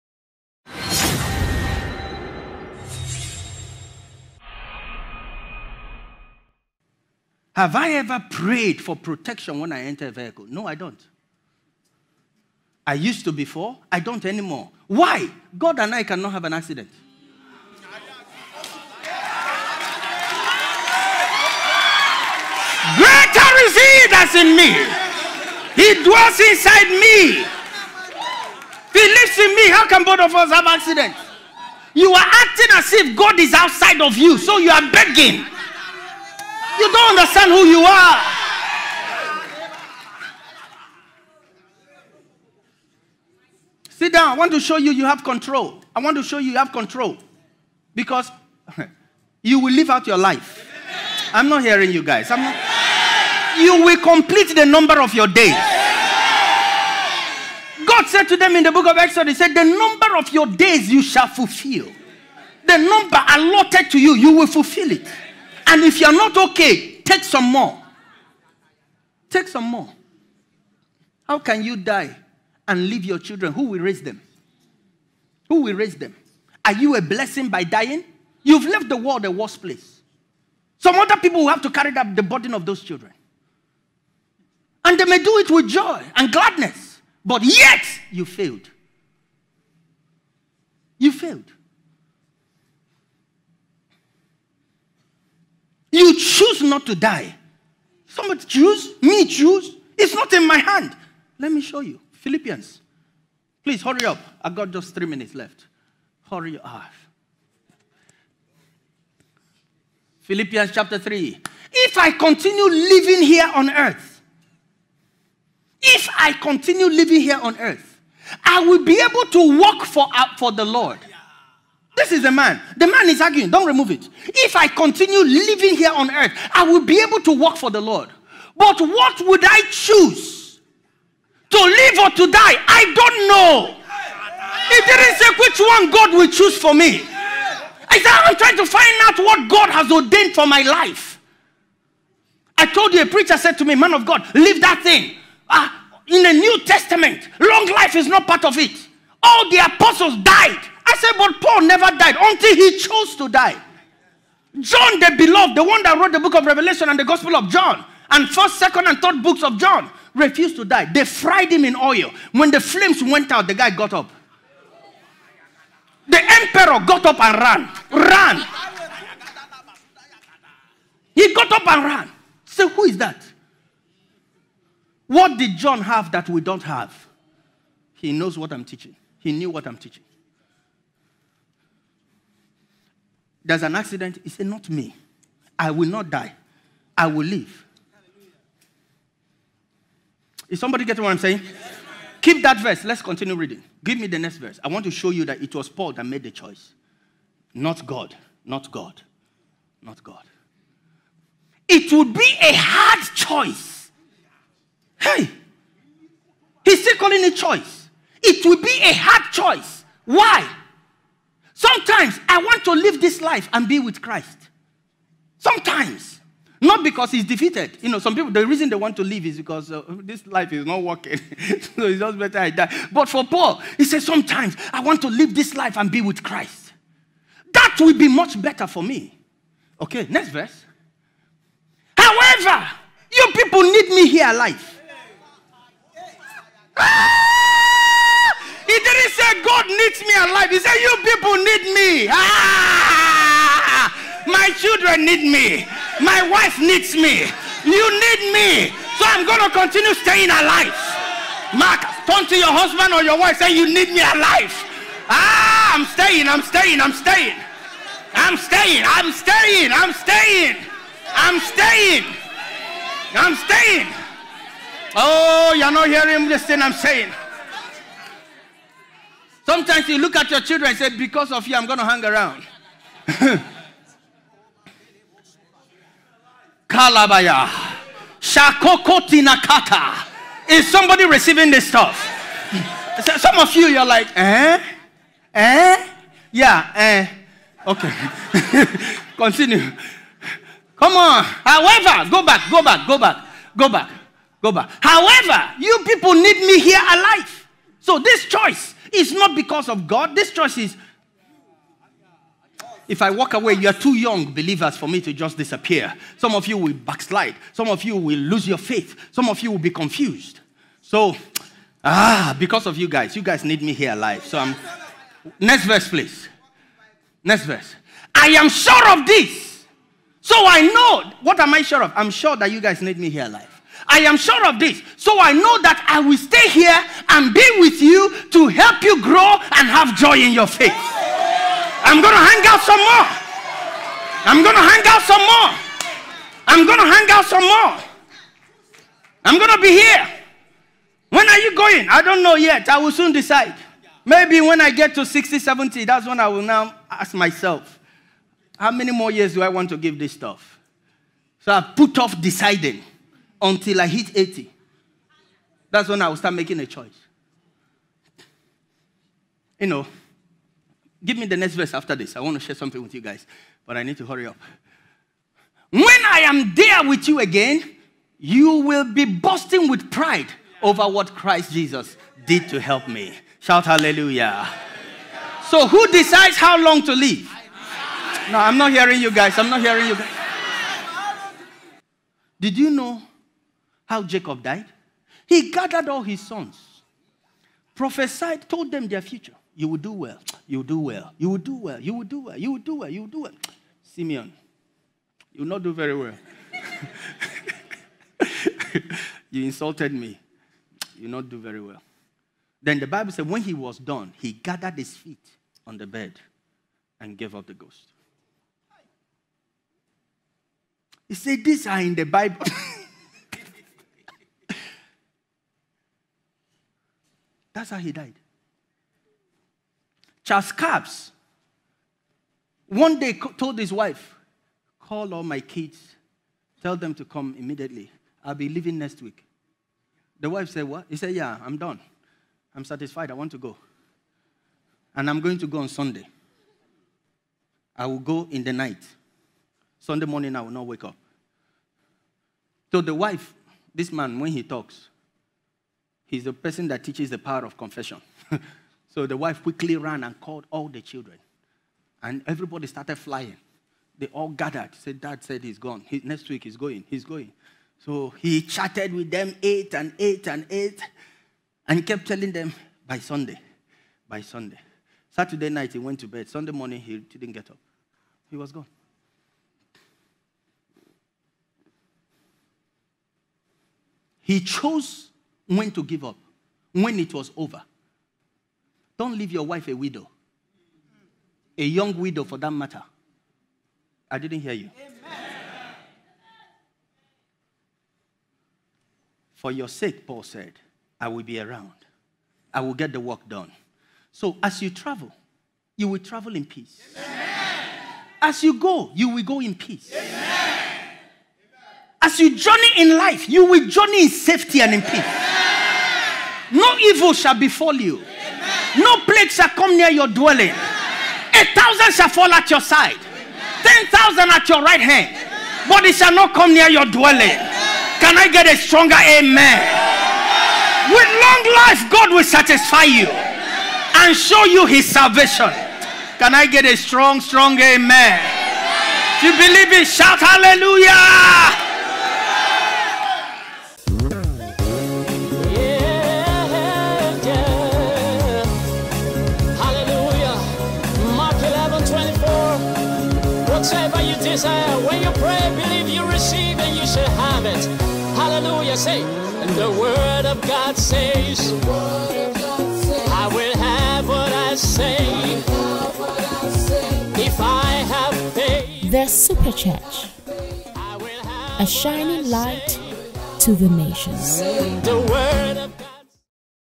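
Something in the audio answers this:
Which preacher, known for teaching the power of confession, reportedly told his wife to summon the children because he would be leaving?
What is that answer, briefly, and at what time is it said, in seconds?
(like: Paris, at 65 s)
Charles Capps, at 420 s.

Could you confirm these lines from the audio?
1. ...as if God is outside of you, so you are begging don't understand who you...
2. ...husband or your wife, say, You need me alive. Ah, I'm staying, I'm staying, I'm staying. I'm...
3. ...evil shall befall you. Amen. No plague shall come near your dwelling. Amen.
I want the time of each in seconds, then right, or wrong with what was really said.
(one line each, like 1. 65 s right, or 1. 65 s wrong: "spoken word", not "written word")
1. 32 s right
2. 252 s right
3. 506 s right.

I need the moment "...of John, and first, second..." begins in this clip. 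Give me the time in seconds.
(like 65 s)
157 s.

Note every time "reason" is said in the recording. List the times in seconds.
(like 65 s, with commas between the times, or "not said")
218 s.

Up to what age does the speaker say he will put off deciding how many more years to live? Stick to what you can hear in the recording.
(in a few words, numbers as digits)
80.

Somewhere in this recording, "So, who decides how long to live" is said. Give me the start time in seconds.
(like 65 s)
375 s.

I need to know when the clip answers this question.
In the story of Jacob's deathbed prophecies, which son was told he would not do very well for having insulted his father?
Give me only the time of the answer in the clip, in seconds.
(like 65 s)
393 s.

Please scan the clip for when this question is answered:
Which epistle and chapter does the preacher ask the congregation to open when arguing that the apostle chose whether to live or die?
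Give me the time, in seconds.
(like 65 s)
110 s.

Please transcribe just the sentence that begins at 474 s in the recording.
He chose when to give up, when it was over.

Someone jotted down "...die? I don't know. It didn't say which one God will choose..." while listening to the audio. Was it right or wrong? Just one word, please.
right.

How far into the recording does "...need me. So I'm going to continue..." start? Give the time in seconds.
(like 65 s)
248 s.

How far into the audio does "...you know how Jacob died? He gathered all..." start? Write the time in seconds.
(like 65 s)
382 s.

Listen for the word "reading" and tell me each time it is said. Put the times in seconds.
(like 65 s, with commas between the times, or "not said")
193 s.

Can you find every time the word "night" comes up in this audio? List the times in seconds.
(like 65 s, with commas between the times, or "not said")
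438 s, 465 s.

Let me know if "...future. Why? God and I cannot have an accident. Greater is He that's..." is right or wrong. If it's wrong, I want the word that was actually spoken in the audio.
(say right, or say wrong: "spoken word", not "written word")
wrong: "anymore", not "future".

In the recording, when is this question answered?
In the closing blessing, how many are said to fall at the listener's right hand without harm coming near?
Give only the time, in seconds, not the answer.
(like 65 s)
513 s.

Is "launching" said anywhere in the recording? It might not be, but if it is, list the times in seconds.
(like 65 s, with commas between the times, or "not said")
not said.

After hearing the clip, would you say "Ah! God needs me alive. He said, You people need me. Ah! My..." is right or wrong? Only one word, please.
right.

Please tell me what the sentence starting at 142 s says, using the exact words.
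I told you, a preacher said to me, Man of God, leave that thing.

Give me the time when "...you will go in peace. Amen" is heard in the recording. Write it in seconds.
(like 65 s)
498 s.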